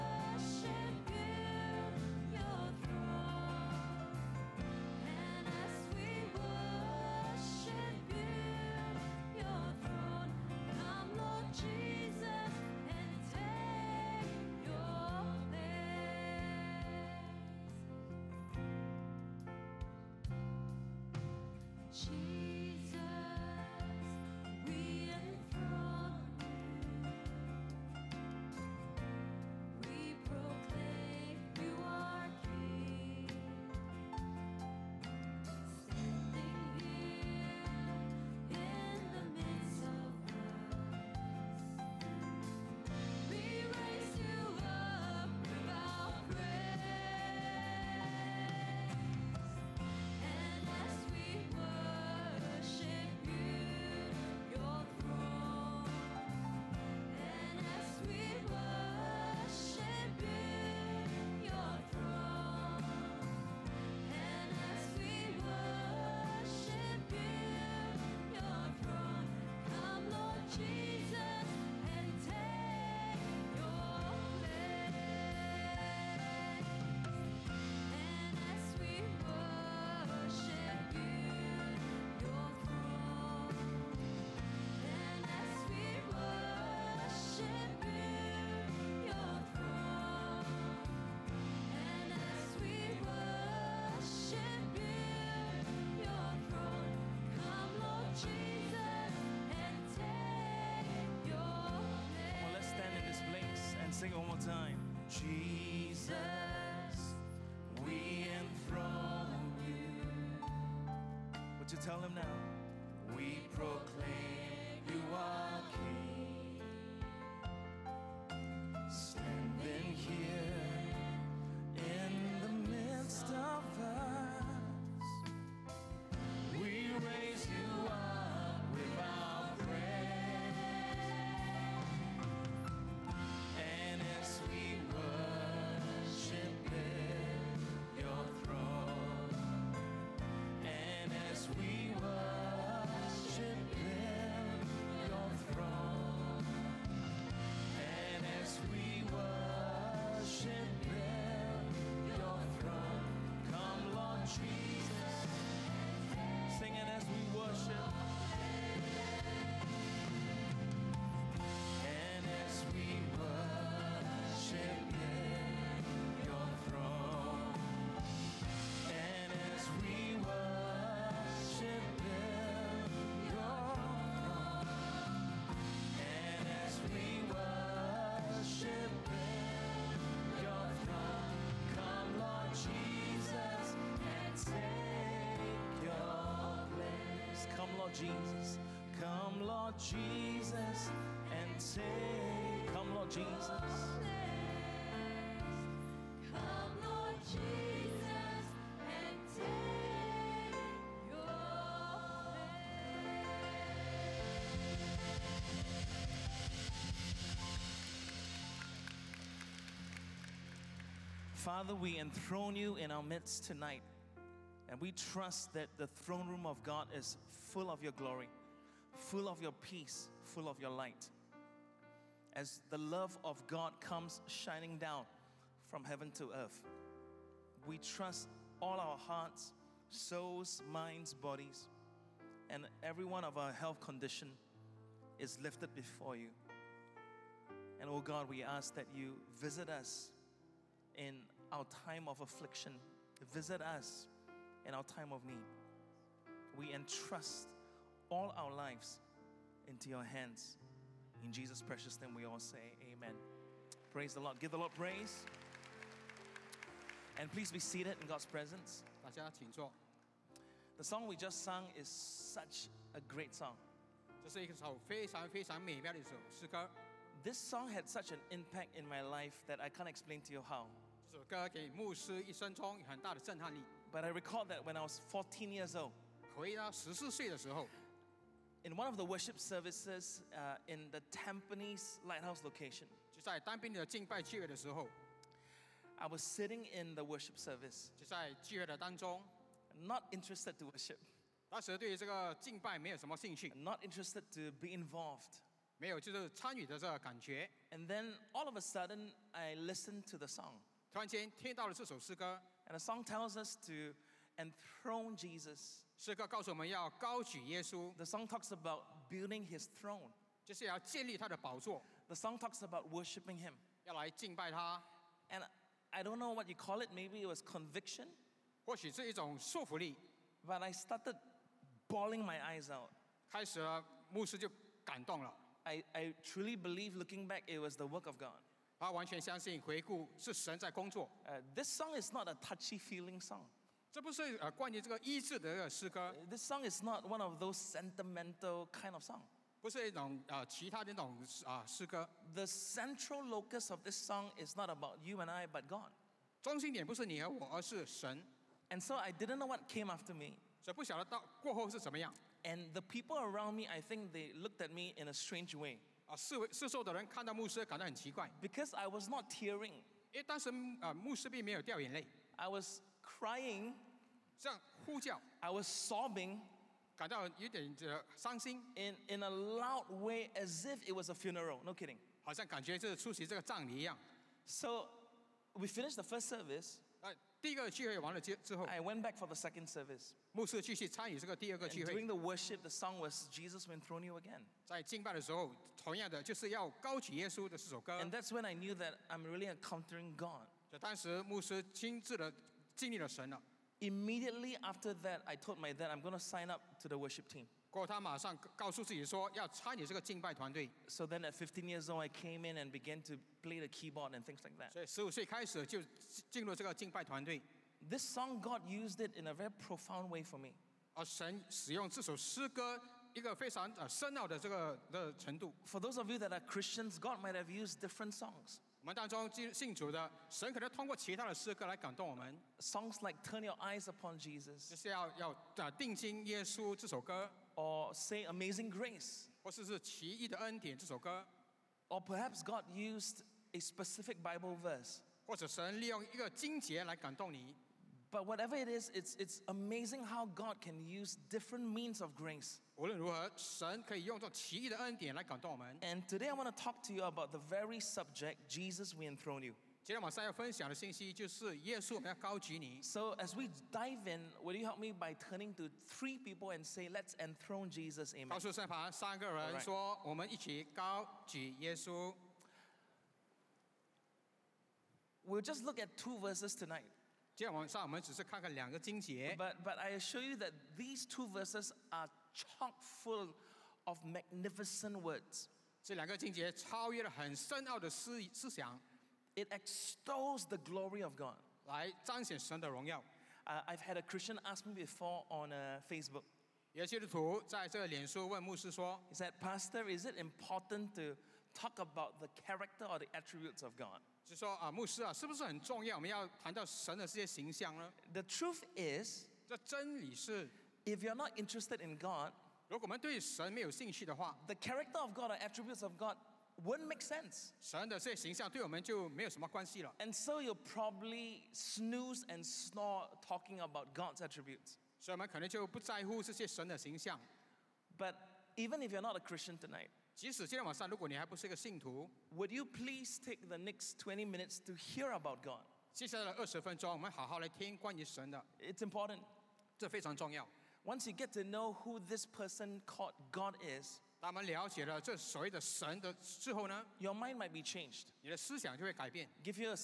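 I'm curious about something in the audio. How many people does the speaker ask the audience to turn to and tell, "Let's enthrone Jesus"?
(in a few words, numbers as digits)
3.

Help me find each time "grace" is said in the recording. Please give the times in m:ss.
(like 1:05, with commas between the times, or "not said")
7:08, 7:22.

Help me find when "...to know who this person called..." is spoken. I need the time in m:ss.
8:51.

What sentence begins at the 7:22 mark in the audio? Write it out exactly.
And today I want to talk to you about the very subject Jesus we enthrone you.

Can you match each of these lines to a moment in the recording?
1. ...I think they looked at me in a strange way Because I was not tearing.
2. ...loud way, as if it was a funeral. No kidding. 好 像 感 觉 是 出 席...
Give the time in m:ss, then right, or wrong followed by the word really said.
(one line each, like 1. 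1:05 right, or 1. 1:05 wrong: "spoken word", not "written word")
1. 5:53 right
2. 6:09 right.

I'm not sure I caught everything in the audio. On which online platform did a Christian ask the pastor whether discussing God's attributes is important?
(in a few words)
Facebook.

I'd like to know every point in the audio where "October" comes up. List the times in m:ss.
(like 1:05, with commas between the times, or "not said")
not said.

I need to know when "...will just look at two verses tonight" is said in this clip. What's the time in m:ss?
7:45.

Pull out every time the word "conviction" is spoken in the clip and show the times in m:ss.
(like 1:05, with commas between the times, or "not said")
5:17.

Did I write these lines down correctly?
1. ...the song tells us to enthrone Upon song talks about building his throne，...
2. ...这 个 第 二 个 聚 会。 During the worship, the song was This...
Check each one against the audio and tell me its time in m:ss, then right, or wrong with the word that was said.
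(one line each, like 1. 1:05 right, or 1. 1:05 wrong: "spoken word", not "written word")
1. 5:02 wrong: "The", not "Upon"
2. 6:21 wrong: "Jesus", not "This".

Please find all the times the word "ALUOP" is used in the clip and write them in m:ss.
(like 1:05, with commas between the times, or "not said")
not said.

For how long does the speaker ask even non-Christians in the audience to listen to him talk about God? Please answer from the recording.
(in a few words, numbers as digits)
20 minutes.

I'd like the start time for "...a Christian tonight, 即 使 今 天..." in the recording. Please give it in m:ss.
8:39.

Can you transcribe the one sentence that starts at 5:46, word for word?
And so I didn't know what came after me.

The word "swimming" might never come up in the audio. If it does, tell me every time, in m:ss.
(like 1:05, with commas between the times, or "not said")
not said.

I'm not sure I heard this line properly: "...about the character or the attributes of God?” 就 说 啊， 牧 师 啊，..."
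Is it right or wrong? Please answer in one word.
right.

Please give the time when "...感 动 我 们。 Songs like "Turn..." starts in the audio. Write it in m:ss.
7:01.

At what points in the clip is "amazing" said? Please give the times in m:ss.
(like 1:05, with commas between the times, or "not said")
7:08, 7:19.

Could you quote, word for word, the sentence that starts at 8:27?
And so you'll probably snooze and snore talking about God's attributes.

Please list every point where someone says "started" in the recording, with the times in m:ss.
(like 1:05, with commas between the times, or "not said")
5:20.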